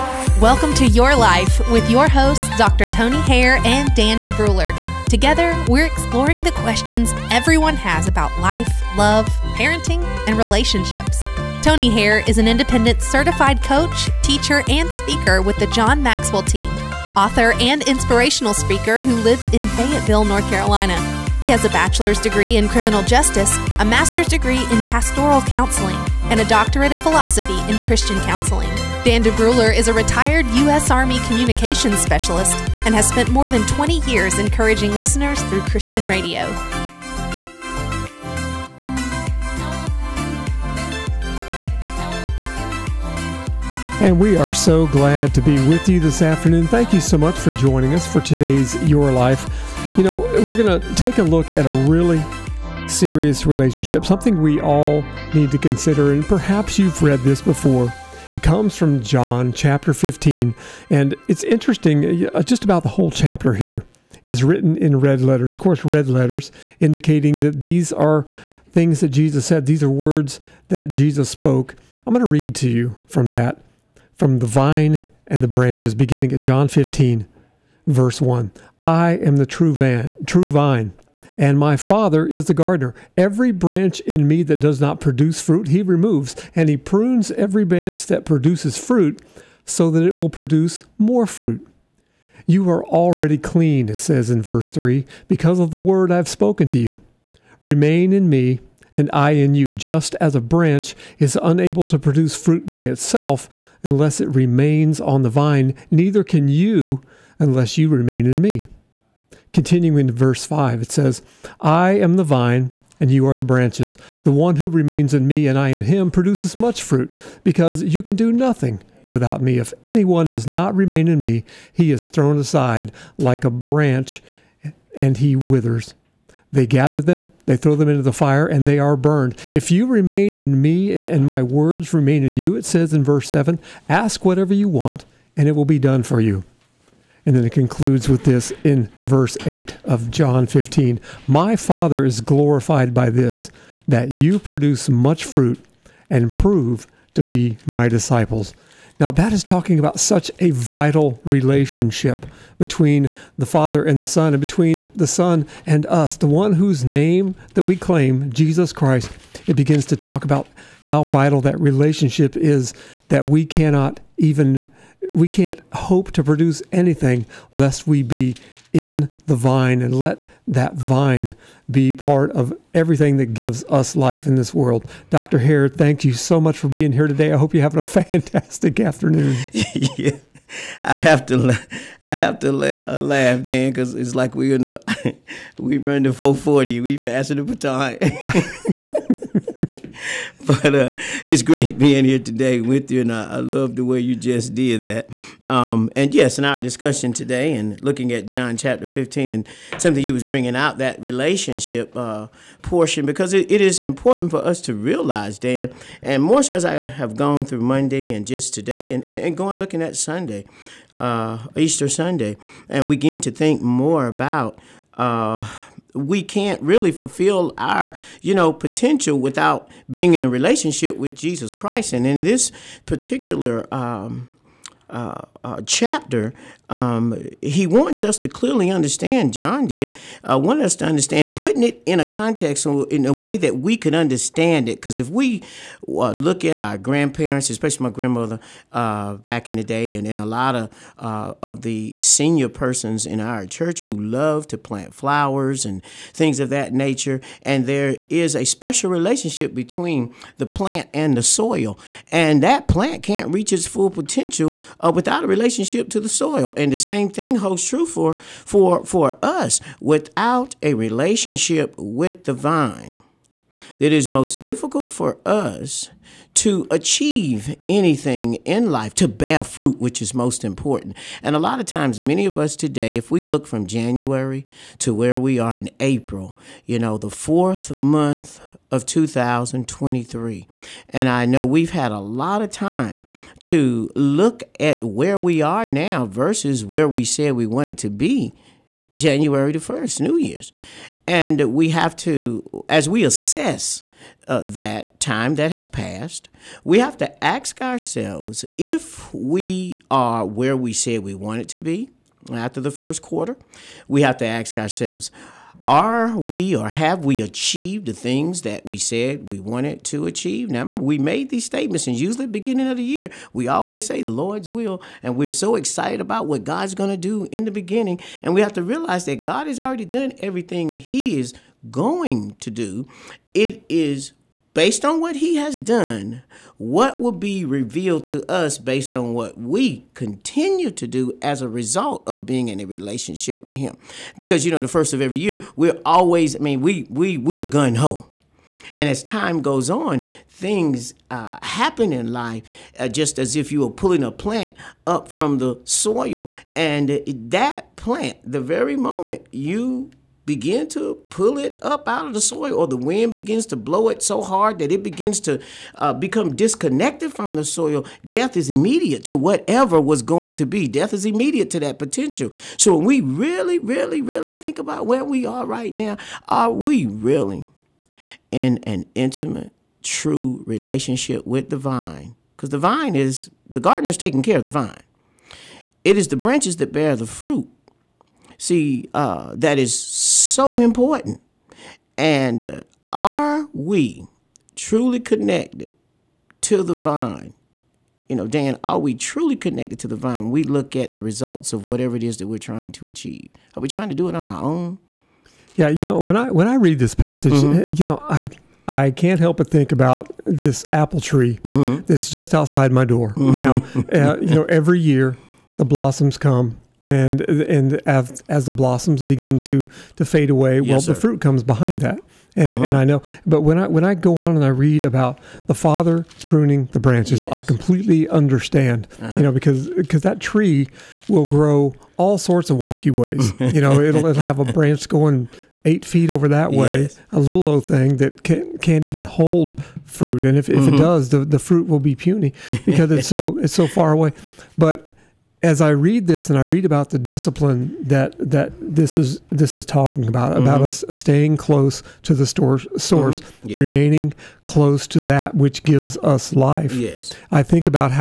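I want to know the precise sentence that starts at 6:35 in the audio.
Yeah, you know, when I when I read this passage, mm-hmm.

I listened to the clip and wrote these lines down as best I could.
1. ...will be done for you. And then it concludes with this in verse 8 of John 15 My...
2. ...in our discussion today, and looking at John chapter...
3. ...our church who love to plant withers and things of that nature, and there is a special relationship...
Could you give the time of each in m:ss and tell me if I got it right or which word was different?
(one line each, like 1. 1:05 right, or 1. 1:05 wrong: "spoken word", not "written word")
1. 2:15 right
2. 3:16 right
3. 4:03 wrong: "flowers", not "withers".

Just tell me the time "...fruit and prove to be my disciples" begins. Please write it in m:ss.
2:25.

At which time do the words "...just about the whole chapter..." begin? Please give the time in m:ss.
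1:02.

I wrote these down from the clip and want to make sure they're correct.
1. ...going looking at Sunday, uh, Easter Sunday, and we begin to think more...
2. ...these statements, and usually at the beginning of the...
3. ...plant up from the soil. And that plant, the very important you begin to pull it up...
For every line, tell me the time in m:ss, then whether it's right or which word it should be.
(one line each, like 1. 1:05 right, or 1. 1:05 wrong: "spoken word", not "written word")
1. 3:29 right
2. 5:11 right
3. 5:44 wrong: "moment", not "important".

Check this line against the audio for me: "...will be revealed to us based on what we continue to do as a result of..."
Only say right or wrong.
right.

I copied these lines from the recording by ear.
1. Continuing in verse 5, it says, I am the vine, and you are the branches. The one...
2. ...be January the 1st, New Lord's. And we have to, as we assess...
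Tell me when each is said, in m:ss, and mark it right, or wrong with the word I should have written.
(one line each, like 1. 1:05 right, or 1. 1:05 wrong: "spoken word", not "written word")
1. 1:49 right
2. 4:47 wrong: "Year", not "Lord".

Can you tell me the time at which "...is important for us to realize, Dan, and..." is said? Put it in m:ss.
3:23.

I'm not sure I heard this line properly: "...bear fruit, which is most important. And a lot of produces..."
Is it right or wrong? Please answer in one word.
wrong.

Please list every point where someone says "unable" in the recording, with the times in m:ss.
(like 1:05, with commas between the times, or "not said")
1:41.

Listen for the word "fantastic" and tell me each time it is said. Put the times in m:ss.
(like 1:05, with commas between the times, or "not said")
2:57.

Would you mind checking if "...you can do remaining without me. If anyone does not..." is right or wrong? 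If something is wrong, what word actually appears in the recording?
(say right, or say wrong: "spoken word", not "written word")
wrong: "nothing", not "remaining".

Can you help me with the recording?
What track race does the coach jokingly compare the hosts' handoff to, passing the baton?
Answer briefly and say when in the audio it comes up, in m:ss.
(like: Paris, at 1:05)
The 440, at 3:06.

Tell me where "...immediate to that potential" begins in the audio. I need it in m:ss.
6:01.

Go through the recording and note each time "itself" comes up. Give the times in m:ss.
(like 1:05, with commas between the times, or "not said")
1:42.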